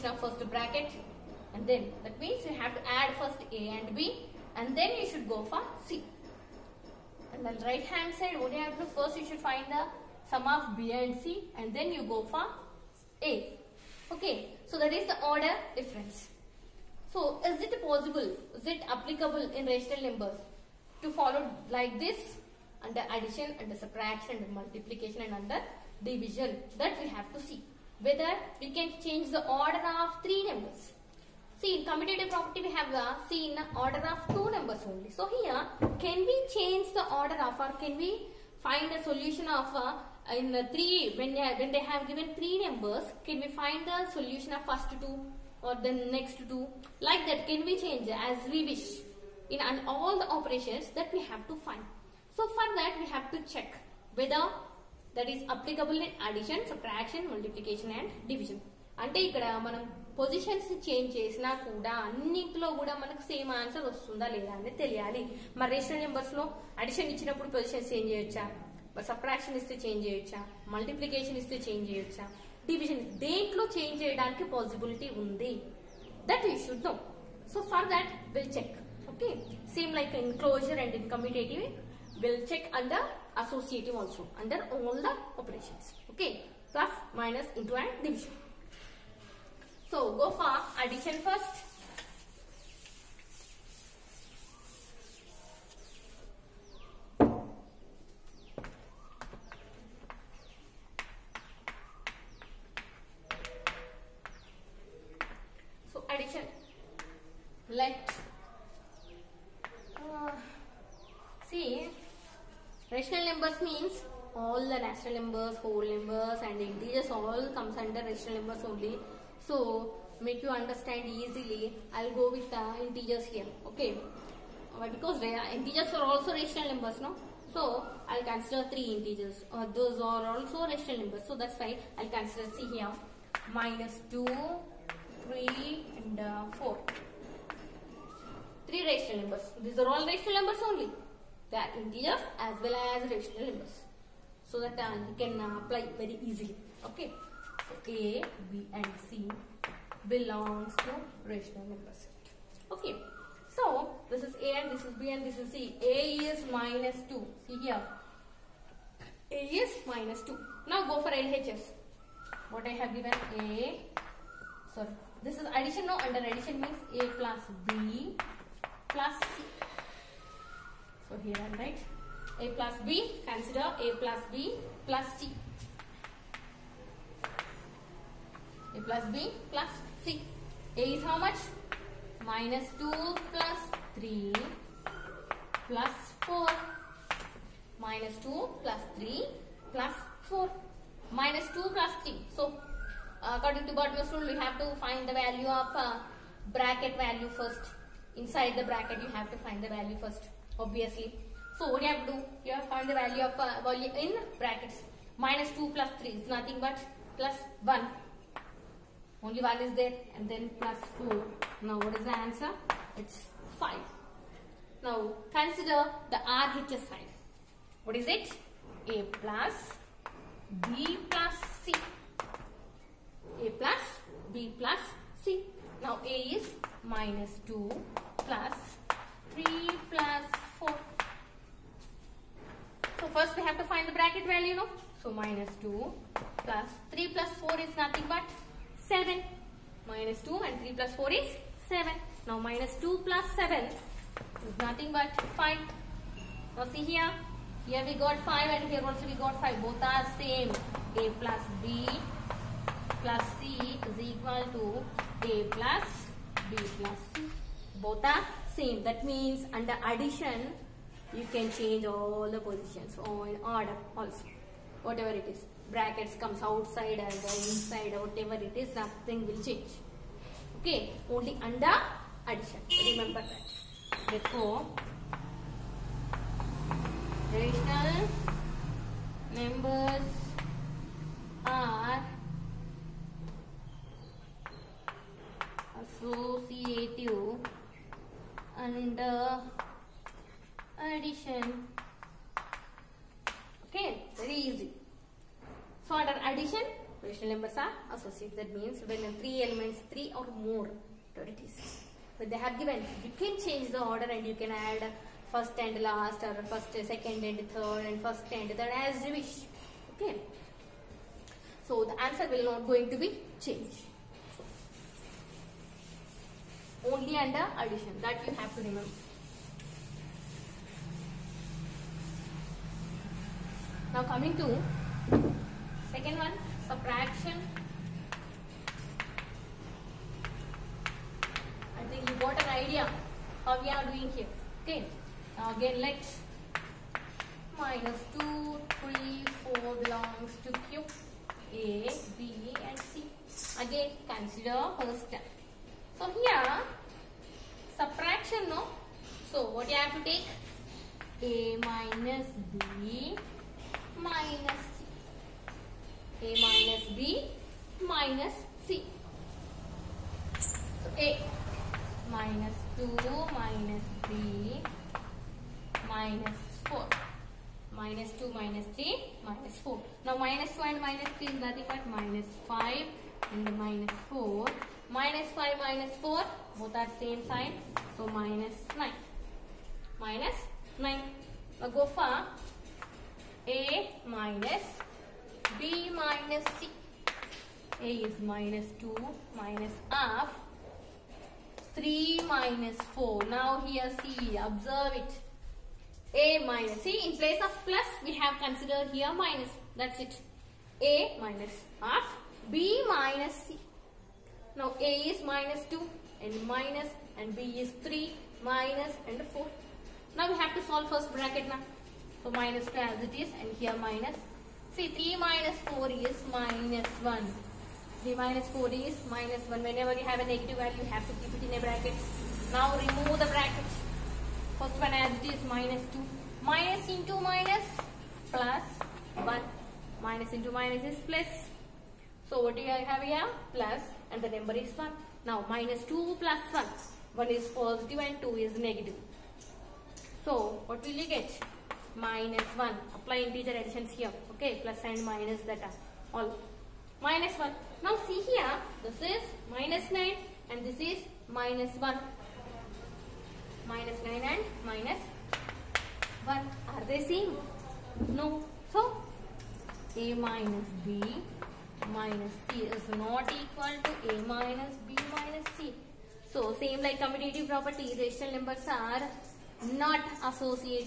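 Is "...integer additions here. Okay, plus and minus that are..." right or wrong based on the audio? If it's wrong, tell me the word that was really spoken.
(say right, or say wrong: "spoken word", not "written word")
right.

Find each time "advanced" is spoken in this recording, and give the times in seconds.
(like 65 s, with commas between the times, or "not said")
not said.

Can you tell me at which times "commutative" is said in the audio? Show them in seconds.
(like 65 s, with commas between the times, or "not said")
31 s, 466 s.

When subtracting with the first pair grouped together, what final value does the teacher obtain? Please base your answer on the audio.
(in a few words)
-9.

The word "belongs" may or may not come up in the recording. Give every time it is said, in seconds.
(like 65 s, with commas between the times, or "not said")
150 s, 339 s.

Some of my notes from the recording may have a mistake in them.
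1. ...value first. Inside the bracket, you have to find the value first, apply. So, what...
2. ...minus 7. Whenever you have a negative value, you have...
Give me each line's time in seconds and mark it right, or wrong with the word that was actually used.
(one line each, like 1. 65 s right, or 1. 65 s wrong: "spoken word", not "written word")
1. 196 s wrong: "obviously", not "apply"
2. 419 s wrong: "1", not "7".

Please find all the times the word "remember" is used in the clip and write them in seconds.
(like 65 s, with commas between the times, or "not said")
272 s, 318 s.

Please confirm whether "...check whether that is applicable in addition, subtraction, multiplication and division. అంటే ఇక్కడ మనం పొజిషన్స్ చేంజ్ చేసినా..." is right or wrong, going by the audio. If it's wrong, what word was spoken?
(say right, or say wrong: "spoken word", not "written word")
right.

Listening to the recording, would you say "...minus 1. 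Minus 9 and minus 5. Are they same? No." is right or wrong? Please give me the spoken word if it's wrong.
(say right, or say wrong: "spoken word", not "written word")
wrong: "1", not "5".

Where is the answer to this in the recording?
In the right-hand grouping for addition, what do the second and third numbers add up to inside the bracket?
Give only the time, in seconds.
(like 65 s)
237 s.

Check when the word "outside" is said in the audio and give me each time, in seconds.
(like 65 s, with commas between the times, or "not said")
266 s.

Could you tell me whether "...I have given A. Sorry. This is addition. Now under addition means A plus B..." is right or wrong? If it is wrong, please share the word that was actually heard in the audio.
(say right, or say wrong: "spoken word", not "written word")
right.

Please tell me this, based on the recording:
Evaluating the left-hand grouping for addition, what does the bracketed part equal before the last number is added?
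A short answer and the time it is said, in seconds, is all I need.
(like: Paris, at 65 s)
1, at 207 s.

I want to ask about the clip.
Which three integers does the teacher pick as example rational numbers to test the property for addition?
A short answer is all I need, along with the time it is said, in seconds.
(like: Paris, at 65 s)
-2, 3 and 4, at 133 s.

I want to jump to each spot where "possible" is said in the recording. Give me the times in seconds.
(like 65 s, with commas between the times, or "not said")
17 s.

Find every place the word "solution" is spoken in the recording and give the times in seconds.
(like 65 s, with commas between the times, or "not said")
39 s, 44 s.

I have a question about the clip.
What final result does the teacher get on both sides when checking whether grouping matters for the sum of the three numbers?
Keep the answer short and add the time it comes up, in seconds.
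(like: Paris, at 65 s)
5, at 212 s.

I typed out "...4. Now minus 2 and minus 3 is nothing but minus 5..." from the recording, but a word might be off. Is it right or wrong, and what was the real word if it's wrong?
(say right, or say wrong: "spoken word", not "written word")
right.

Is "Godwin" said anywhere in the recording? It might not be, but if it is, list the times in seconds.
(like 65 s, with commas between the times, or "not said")
193 s.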